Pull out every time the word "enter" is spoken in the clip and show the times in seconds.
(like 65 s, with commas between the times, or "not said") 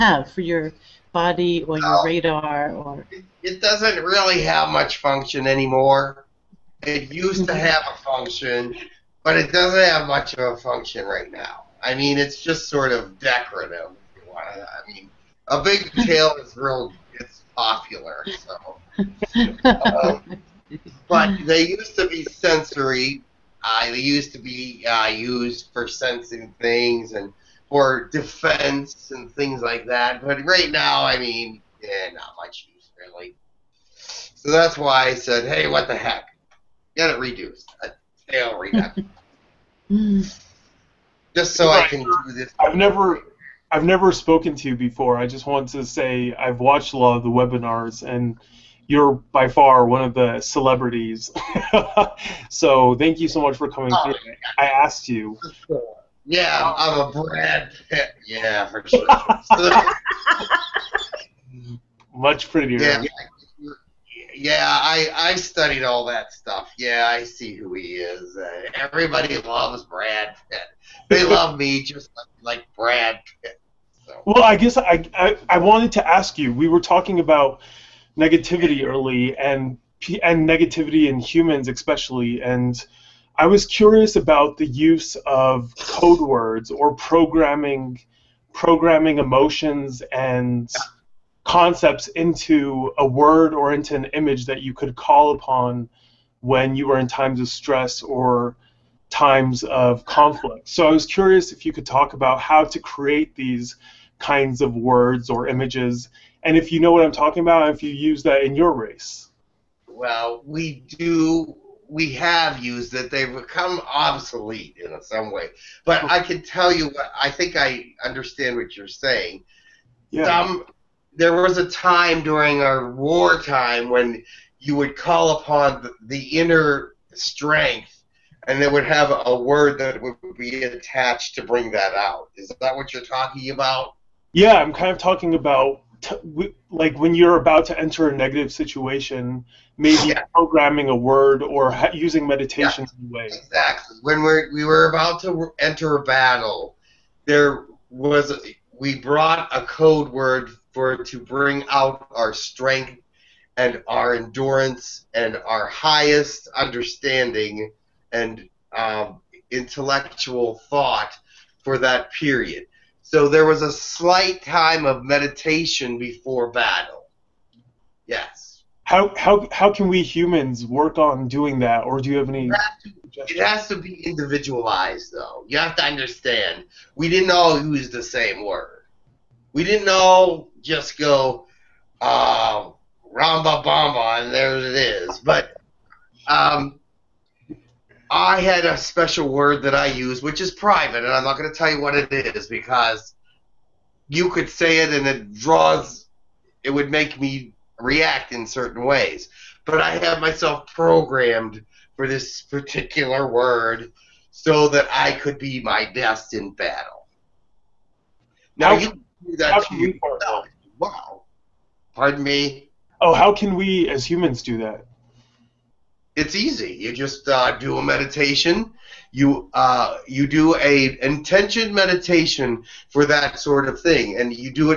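137 s, 145 s.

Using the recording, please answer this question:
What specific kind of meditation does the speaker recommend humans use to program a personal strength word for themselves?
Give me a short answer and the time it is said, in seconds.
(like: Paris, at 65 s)
Intention meditation, at 221 s.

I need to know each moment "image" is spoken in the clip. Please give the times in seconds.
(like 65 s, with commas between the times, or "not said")
94 s, 105 s.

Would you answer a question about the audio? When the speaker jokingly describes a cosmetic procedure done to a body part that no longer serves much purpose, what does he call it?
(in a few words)
A tail reduction.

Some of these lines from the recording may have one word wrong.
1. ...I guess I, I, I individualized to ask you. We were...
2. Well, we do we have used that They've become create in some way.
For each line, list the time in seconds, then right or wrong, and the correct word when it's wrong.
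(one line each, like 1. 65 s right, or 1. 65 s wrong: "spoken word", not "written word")
1. 74 s wrong: "wanted", not "individualized"
2. 109 s wrong: "obsolete", not "create".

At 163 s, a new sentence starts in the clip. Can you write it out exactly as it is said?
So there was a slight time of meditation before battle.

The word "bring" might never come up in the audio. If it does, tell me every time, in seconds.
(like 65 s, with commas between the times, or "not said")
131 s, 151 s.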